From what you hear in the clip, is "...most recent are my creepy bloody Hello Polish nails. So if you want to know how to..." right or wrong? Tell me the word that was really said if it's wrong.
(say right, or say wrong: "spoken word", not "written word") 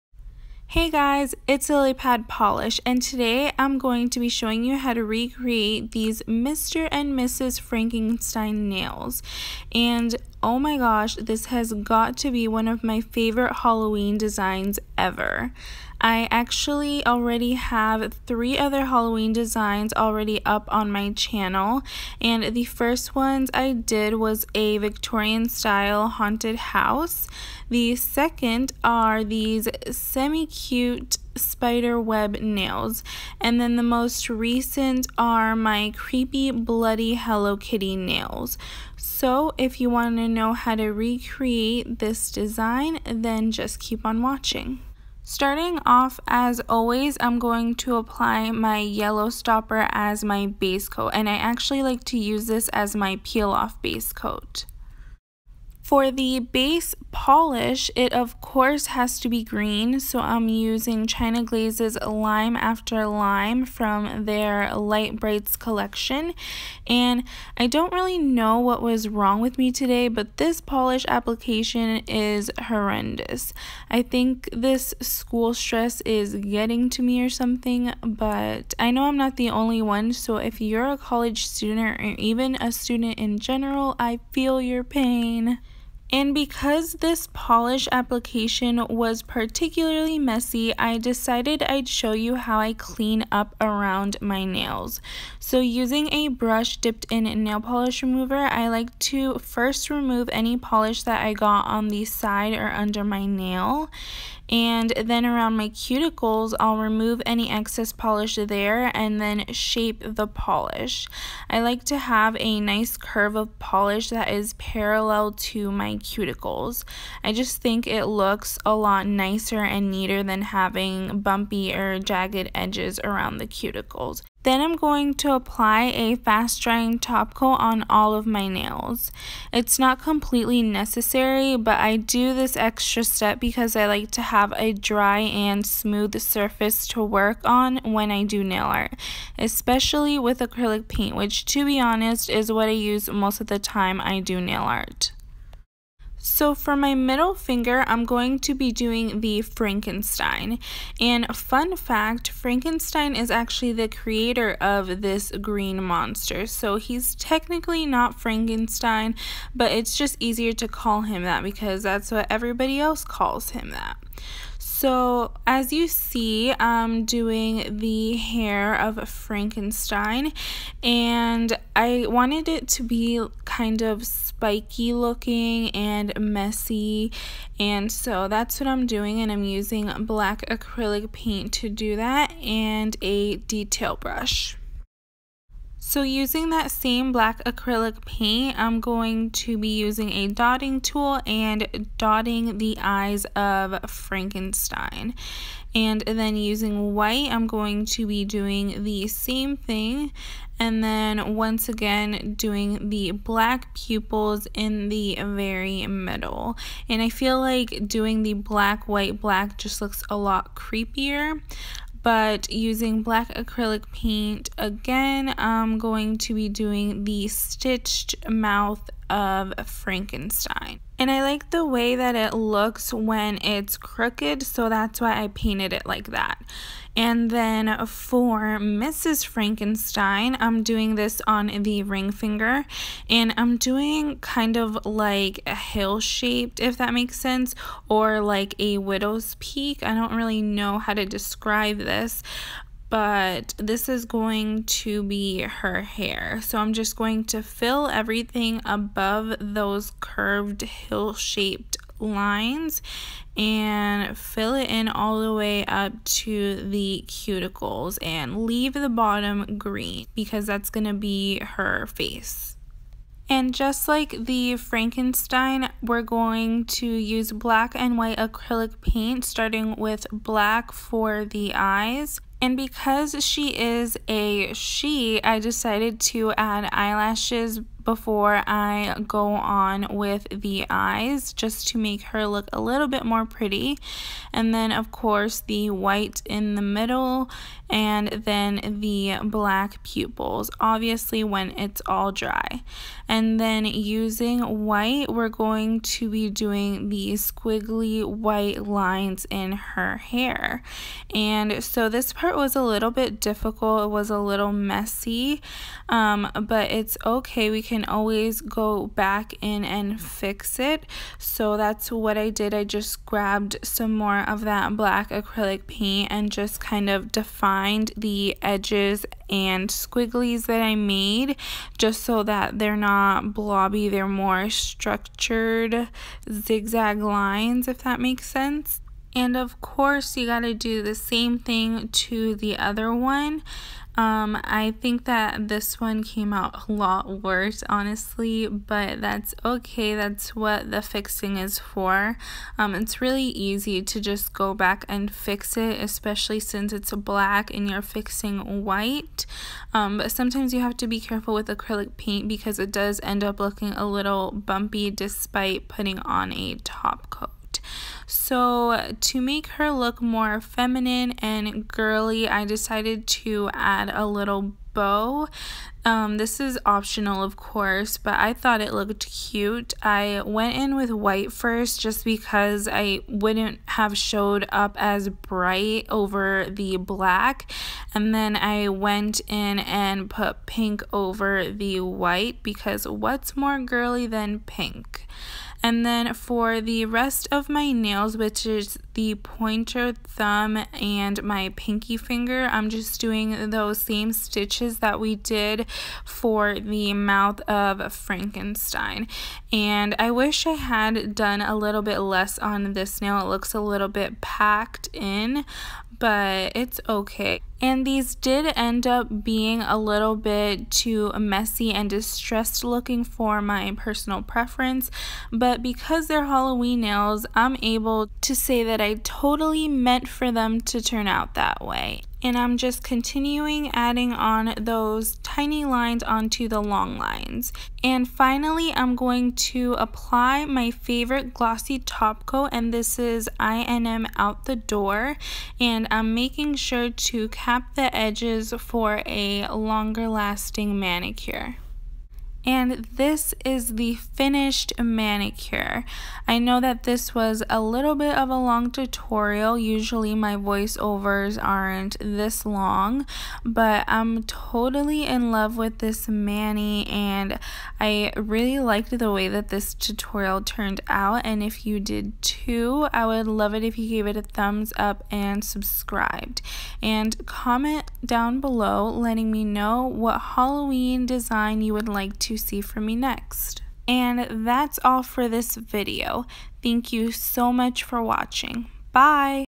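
wrong: "Kitty", not "Polish".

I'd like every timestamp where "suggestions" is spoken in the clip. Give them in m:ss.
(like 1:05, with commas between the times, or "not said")
not said.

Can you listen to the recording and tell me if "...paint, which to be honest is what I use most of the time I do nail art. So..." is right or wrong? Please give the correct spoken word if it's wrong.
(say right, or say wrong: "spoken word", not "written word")
right.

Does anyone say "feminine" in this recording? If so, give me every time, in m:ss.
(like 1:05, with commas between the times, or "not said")
6:00.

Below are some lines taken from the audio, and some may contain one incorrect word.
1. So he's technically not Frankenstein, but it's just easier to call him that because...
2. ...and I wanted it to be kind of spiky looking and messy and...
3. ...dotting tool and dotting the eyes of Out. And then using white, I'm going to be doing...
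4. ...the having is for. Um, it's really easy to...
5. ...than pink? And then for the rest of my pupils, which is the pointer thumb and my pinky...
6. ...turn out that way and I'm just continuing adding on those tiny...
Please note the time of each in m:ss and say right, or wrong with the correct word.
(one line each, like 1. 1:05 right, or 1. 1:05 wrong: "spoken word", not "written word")
1. 2:36 right
2. 2:50 right
3. 3:10 wrong: "Frankenstein", not "Out"
4. 5:40 wrong: "fixing", not "having"
5. 6:24 wrong: "nails", not "pupils"
6. 7:00 right.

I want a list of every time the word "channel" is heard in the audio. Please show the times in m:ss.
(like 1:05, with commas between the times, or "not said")
0:21.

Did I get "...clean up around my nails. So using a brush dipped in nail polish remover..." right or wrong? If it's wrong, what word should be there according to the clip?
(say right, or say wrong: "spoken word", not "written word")
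right.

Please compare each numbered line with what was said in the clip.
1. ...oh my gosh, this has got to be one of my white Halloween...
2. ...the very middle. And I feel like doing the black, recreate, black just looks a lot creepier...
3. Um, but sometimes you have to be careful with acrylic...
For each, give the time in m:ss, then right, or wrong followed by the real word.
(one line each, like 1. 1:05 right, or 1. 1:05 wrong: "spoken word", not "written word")
1. 0:10 wrong: "favorite", not "white"
2. 3:24 wrong: "white", not "recreate"
3. 5:49 right.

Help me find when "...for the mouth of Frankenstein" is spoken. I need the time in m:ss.
6:36.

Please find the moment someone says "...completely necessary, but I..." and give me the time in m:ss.
2:10.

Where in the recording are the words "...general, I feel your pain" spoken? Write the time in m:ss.
1:23.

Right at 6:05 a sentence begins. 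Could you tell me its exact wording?
Um, this is optional, of course, but I thought it looked cute.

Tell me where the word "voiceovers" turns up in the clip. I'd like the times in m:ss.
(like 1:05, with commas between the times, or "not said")
7:30.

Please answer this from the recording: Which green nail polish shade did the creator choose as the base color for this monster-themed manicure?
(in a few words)
Lime After Lime.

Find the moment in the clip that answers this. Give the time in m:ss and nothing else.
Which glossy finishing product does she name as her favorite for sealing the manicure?
7:13.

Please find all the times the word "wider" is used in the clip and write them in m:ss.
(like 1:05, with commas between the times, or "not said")
not said.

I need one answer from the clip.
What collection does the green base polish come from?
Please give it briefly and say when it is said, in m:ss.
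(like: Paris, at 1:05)
Light Brights, at 1:04.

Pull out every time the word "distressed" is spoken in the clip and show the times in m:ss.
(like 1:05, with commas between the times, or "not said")
6:51.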